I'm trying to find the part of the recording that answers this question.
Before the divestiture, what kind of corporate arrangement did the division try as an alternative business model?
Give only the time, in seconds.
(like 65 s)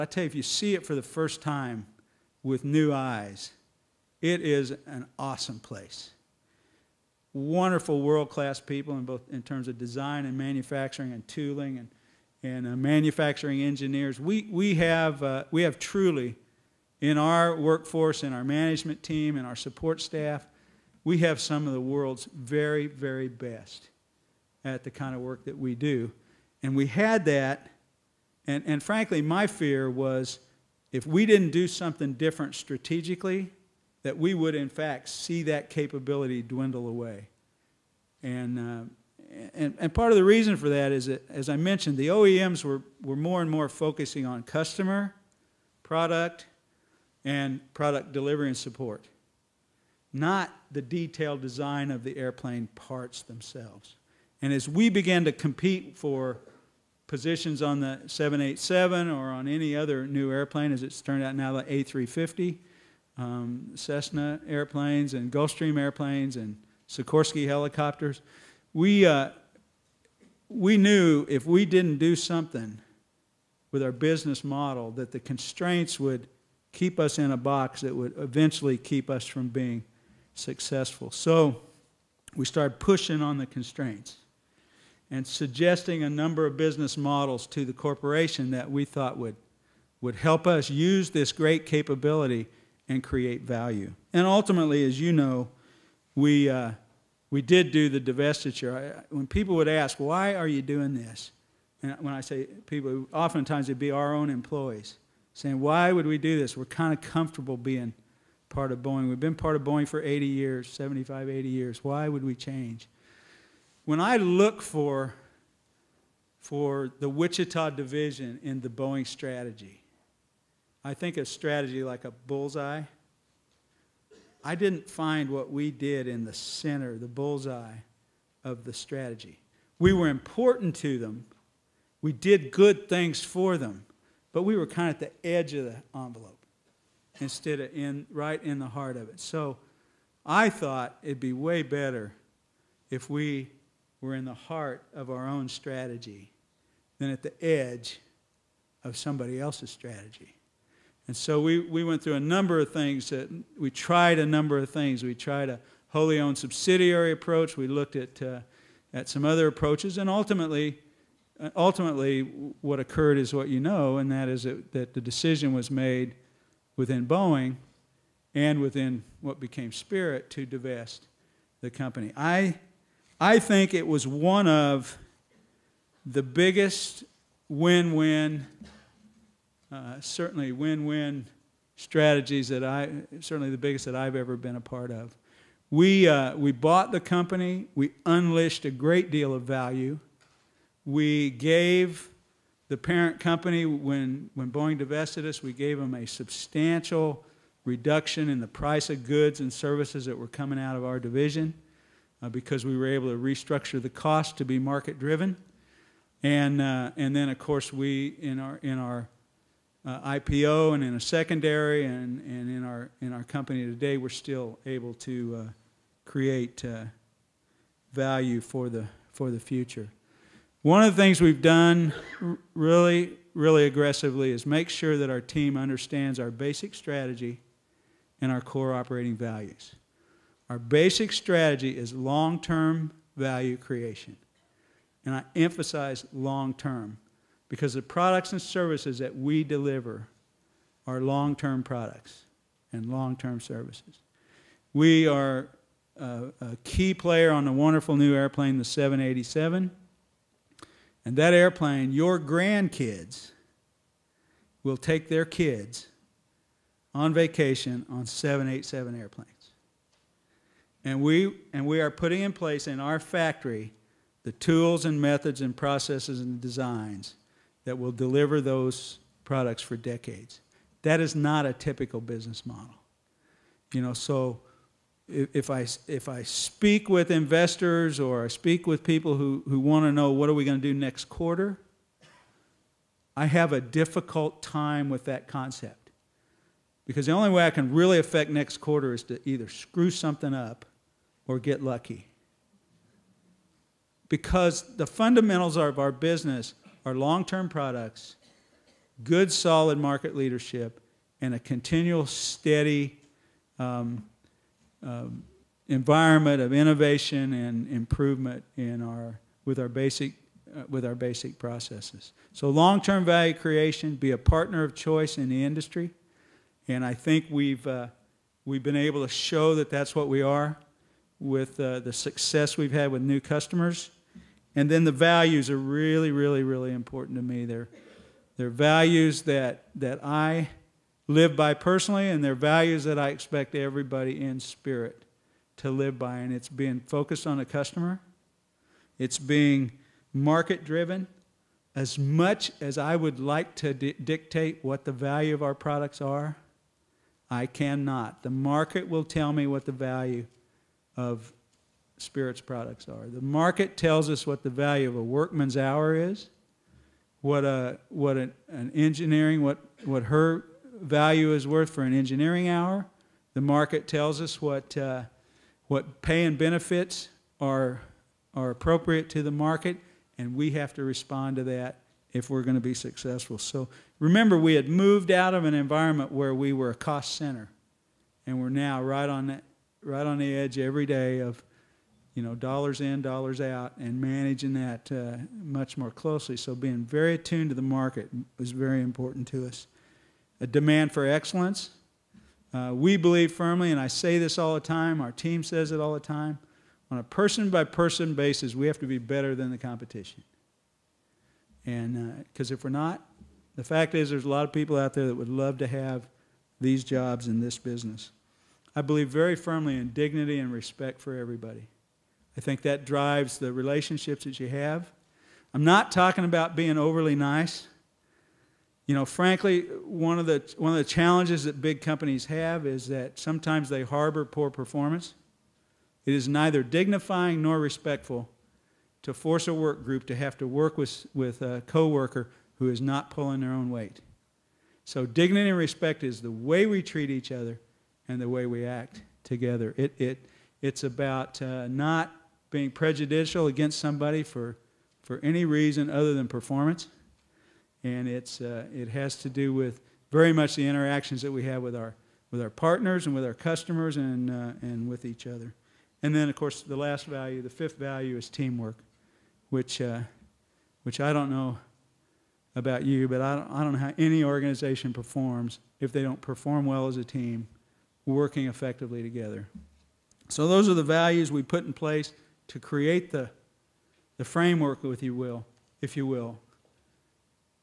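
155 s.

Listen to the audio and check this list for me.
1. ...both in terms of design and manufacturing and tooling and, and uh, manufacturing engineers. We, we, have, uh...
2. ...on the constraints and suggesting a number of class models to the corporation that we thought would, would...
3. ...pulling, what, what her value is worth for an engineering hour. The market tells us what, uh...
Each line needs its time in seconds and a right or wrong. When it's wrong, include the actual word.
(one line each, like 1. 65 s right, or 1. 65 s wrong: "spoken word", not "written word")
1. 9 s right
2. 83 s wrong: "business", not "class"
3. 358 s wrong: "engineering", not "pulling".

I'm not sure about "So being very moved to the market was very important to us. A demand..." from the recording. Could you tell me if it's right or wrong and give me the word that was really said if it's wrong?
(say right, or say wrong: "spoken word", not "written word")
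wrong: "attuned", not "moved".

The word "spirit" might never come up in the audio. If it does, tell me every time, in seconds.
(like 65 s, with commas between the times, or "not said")
169 s, 334 s, 351 s.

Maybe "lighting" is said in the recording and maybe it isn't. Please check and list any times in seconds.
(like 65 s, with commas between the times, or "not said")
not said.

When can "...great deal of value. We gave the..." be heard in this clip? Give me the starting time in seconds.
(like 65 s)
188 s.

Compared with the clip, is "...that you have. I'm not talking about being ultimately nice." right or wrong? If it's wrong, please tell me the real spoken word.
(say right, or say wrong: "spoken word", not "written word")
wrong: "overly", not "ultimately".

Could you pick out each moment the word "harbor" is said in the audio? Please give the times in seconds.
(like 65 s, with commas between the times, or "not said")
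423 s.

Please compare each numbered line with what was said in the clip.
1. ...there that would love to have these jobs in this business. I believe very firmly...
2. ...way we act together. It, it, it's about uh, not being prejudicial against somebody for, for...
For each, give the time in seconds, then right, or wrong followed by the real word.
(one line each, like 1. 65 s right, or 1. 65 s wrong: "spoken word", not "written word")
1. 404 s right
2. 438 s right.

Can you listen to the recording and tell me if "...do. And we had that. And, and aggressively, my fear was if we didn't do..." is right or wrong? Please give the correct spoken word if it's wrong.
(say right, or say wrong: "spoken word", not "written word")
wrong: "frankly", not "aggressively".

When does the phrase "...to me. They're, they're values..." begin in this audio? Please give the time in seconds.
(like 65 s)
327 s.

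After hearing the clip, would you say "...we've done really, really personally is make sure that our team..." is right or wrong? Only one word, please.
wrong.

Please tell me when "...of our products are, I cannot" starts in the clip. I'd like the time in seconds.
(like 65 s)
345 s.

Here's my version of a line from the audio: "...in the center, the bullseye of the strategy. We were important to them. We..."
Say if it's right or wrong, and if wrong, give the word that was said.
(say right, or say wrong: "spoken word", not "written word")
right.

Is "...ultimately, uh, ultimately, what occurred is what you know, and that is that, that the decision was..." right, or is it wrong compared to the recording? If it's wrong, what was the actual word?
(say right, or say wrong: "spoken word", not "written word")
right.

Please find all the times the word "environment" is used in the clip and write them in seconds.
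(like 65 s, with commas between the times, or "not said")
305 s, 375 s.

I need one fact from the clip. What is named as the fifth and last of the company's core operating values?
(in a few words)
teamwork.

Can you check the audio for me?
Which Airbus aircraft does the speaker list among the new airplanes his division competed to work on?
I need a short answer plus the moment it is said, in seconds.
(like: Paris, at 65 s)
A350, at 61 s.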